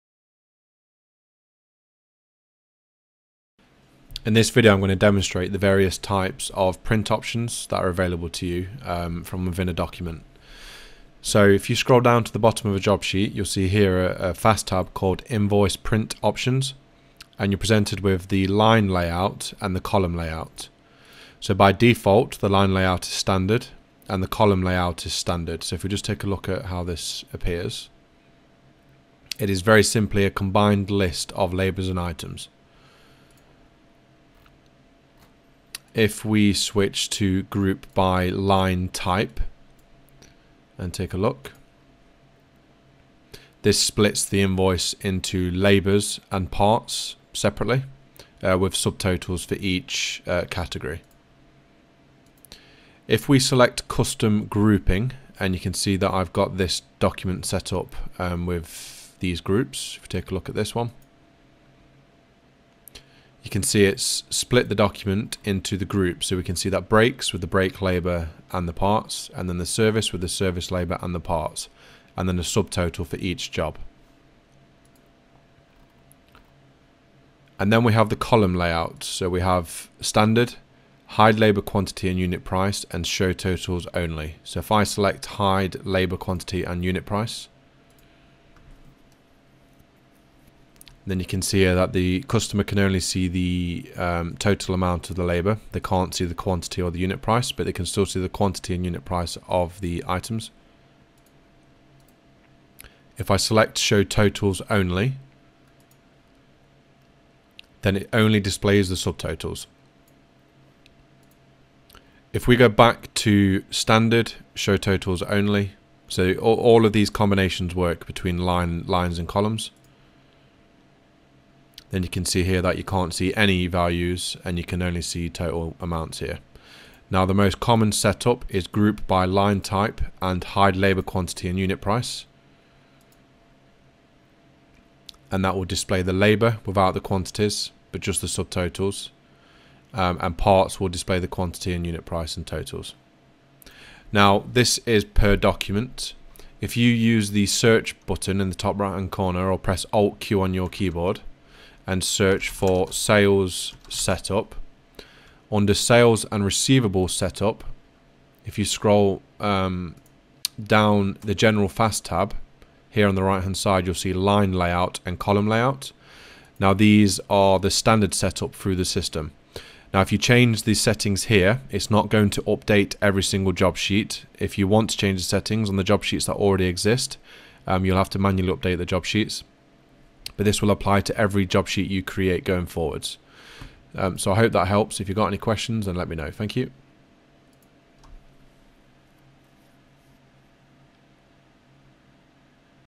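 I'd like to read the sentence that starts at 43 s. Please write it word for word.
This splits the invoice into labors and parts separately uh, with subtotals for each uh, category.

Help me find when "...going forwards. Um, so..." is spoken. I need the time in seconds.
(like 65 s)
182 s.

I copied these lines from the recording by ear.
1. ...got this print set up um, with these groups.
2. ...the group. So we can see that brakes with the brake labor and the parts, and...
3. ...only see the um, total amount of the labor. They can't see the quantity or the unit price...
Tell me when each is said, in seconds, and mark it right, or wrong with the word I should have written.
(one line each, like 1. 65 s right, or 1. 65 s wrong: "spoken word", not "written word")
1. 56 s wrong: "document", not "print"
2. 65 s right
3. 92 s right.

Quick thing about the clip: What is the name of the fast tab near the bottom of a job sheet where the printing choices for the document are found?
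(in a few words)
Invoice print options.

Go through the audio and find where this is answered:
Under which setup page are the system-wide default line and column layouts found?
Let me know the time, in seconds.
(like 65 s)
155 s.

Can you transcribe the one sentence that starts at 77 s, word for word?
And then we have the column layout.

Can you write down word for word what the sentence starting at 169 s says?
Now if you change these settings here, it's not going to update every single job sheet.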